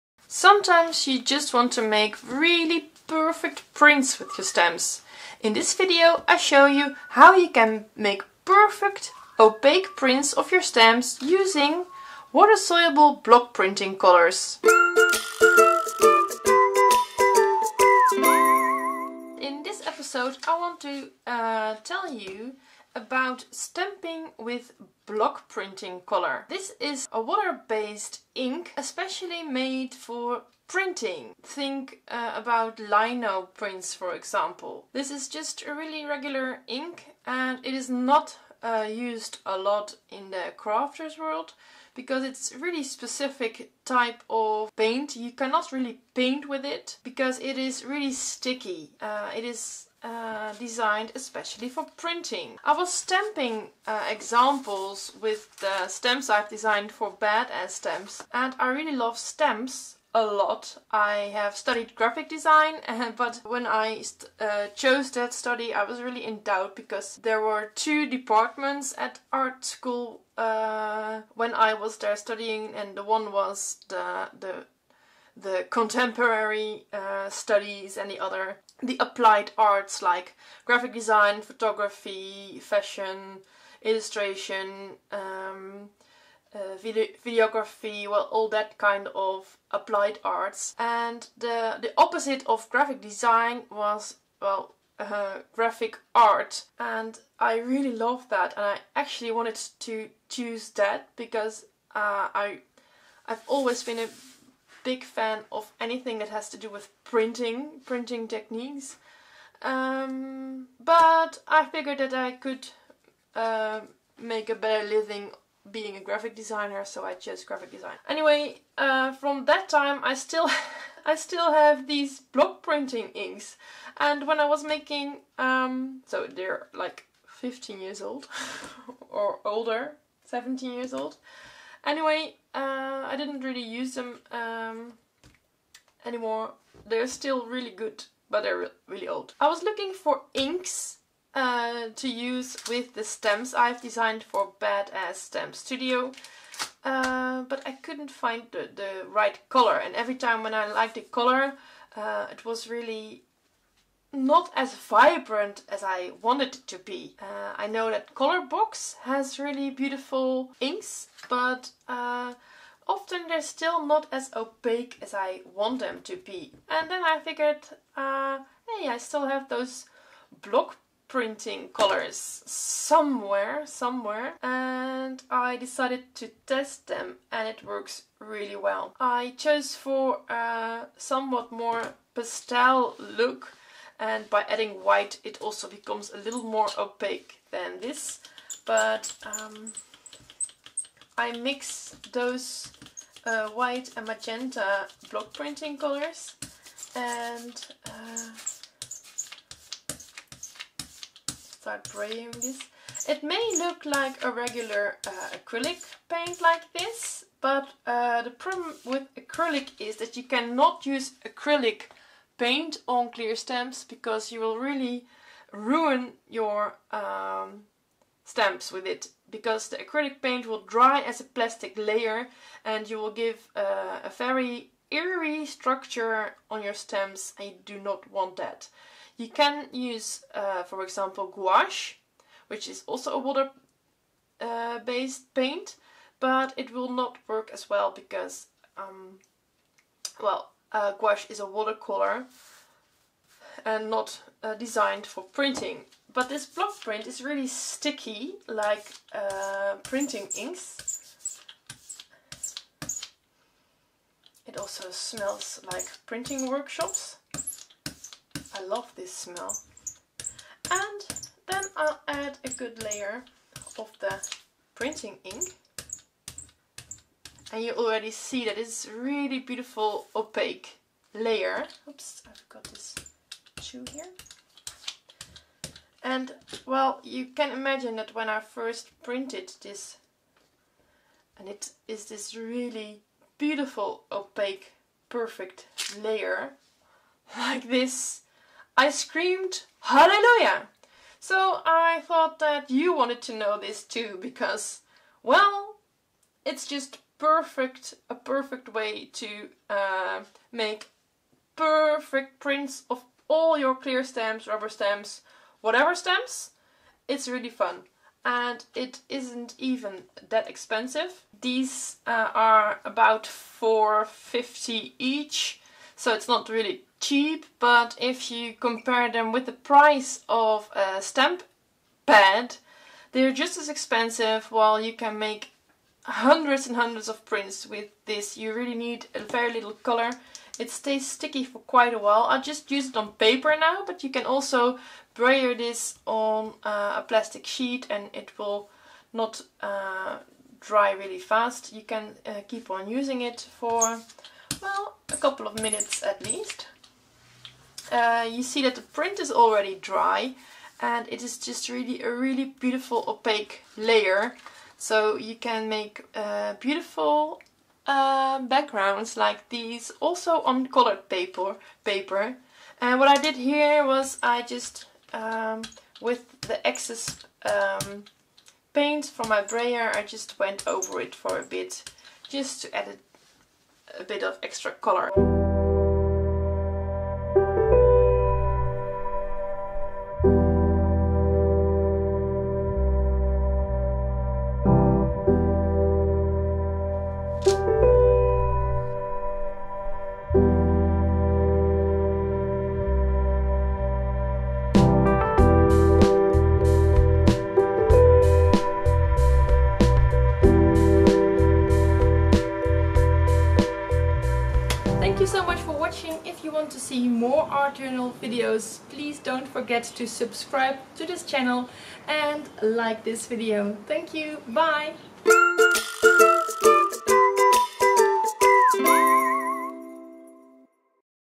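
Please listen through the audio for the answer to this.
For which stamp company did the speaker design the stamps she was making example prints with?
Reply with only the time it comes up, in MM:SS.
02:24.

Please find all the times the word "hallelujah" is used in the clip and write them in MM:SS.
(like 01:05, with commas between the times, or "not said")
04:49.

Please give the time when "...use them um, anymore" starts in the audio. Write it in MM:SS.
02:13.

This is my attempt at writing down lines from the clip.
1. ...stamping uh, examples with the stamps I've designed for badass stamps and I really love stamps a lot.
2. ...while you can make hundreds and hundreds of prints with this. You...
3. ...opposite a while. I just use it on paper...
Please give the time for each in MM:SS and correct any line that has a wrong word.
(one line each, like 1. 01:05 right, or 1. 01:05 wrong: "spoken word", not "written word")
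1. 00:52 right
2. 05:24 right
3. 05:31 wrong: "quite", not "opposite".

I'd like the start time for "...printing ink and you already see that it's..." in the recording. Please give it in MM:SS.
04:24.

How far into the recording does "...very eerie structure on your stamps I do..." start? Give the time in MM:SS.
03:44.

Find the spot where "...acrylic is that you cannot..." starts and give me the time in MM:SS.
03:29.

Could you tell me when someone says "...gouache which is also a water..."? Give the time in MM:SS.
03:51.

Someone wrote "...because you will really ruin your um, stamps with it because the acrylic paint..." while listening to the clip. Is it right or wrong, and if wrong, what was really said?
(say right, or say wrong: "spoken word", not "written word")
right.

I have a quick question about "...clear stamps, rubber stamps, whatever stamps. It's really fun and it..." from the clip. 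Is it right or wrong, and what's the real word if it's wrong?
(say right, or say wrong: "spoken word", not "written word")
right.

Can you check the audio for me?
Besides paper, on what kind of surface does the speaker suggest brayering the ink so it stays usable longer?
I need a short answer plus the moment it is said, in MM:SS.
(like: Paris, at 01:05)
A plastic sheet, at 05:37.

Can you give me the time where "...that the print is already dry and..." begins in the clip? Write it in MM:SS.
05:48.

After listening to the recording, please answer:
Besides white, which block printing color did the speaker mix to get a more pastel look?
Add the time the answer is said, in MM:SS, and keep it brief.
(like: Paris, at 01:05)
Magenta, at 03:14.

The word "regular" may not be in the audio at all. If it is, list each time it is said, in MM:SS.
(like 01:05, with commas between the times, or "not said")
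00:36, 03:24.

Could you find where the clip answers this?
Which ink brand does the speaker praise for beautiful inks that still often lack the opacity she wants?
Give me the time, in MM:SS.
02:38.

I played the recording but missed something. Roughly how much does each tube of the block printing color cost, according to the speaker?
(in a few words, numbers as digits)
4.50.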